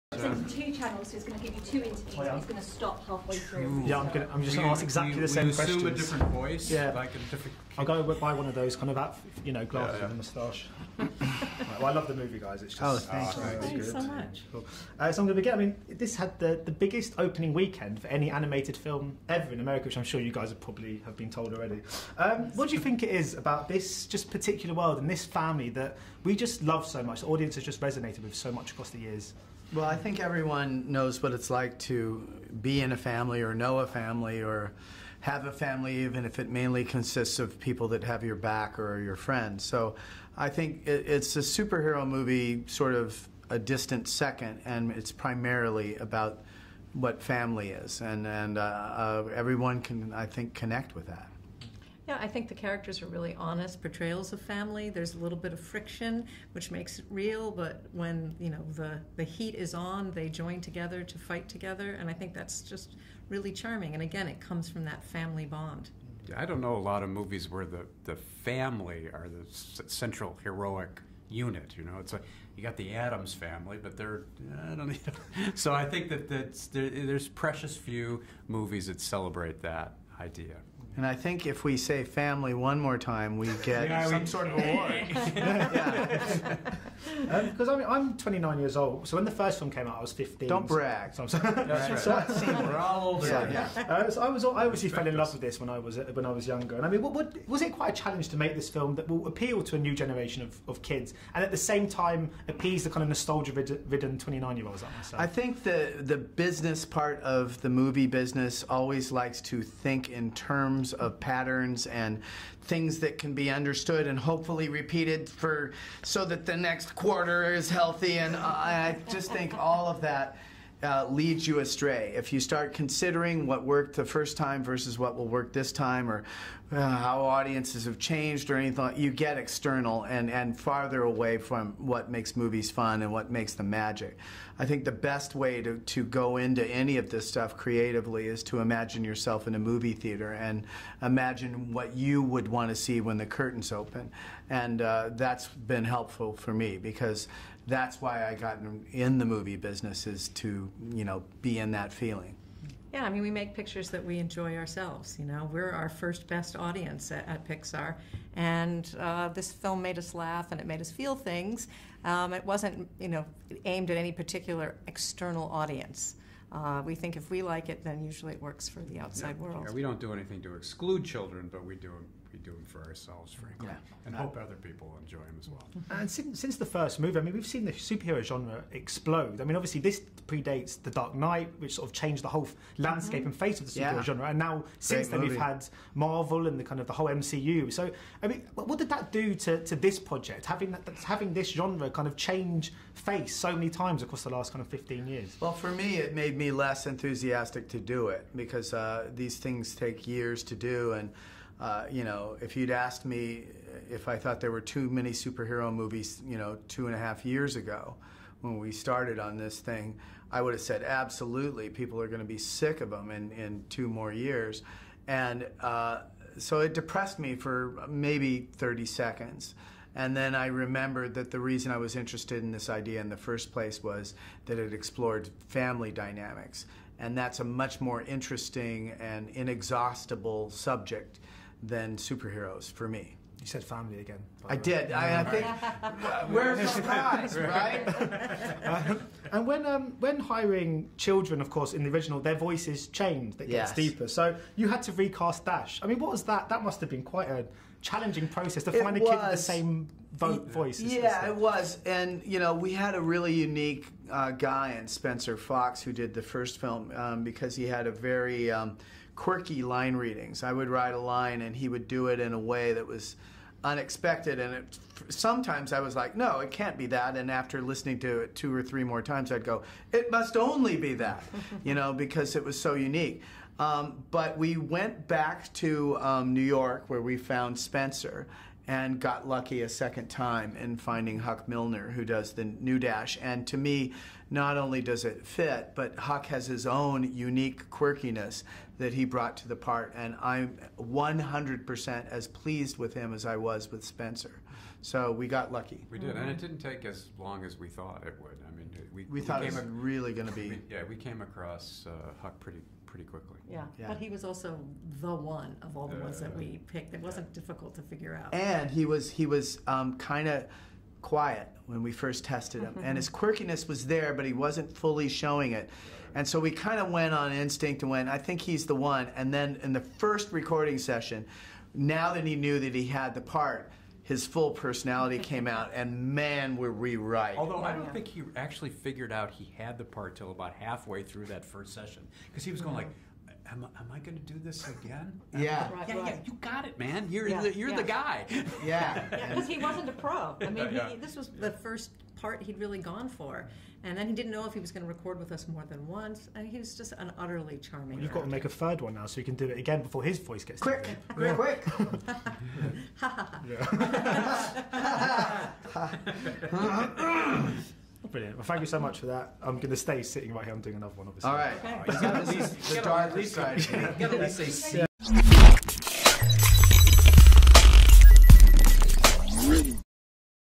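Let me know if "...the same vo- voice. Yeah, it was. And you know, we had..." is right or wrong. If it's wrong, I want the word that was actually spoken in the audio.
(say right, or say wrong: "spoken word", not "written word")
right.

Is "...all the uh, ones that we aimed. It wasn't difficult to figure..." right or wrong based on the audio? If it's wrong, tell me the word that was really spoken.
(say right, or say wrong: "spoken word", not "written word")
wrong: "picked", not "aimed".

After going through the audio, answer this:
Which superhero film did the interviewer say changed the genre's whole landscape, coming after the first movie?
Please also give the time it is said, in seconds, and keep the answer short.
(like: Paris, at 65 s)
The Dark Knight, at 180 s.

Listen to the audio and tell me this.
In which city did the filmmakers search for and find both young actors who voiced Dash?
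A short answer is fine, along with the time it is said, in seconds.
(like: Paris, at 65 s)
New York, at 276 s.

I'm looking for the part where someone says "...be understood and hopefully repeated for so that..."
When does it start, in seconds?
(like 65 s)
113 s.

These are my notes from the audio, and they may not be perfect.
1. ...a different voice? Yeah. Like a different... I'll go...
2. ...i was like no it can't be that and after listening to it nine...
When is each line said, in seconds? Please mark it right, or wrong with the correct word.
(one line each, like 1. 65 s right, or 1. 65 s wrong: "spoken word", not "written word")
1. 5 s right
2. 265 s wrong: "two", not "nine".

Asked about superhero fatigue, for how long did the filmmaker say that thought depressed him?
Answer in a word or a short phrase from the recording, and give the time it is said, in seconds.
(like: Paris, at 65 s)
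30 seconds, at 218 s.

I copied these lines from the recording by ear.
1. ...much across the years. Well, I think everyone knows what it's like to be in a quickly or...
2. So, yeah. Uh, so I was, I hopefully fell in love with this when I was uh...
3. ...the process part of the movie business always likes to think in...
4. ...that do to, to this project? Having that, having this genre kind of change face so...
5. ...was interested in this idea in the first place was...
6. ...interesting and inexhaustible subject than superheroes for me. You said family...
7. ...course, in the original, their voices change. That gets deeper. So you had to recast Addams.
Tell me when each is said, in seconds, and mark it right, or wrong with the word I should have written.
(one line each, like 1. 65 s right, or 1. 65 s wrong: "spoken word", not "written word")
1. 28 s wrong: "family", not "quickly"
2. 93 s wrong: "obviously", not "hopefully"
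3. 106 s wrong: "business", not "process"
4. 188 s right
5. 221 s right
6. 228 s right
7. 241 s wrong: "Dash", not "Addams".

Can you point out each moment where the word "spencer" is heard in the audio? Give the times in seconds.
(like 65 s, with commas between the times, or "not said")
254 s, 277 s, 293 s.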